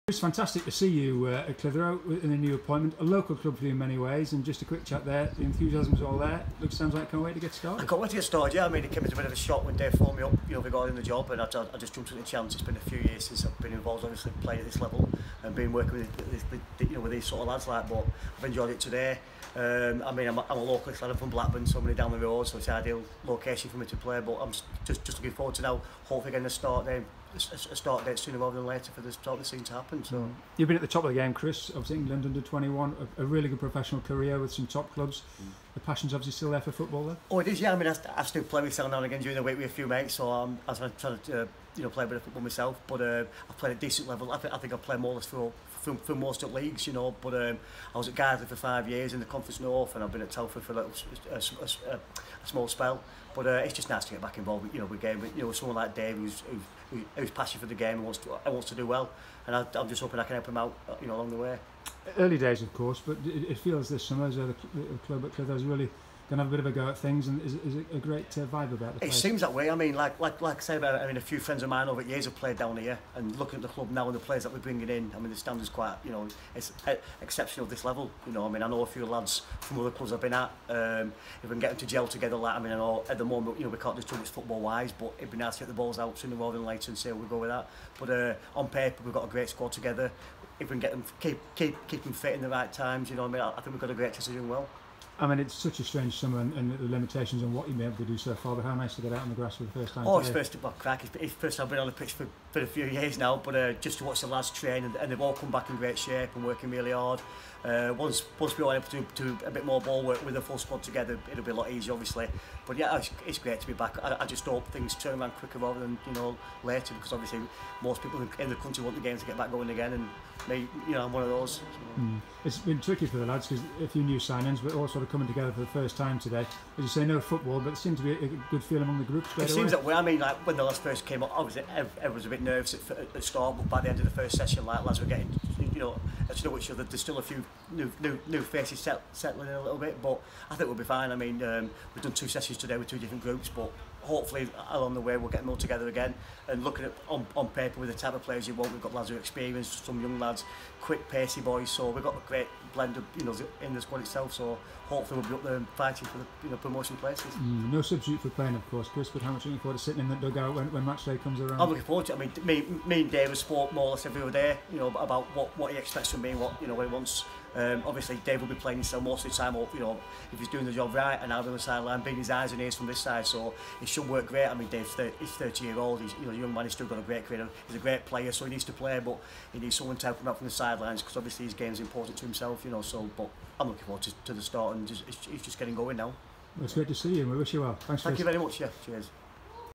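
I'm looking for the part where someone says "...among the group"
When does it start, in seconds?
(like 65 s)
128 s.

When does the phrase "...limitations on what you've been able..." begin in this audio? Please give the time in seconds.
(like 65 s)
96 s.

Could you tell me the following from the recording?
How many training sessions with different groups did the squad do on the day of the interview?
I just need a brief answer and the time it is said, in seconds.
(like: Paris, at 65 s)
2, at 142 s.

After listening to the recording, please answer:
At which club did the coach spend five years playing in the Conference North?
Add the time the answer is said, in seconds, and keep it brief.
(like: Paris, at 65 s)
Gardley, at 48 s.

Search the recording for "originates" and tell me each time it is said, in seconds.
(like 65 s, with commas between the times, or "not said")
not said.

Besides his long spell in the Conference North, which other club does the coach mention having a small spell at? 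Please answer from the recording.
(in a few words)
Telford.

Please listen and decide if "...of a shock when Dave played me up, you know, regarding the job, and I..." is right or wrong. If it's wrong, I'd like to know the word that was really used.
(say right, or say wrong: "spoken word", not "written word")
wrong: "phoned", not "played".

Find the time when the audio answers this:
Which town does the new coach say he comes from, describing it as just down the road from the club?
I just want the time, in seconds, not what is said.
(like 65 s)
21 s.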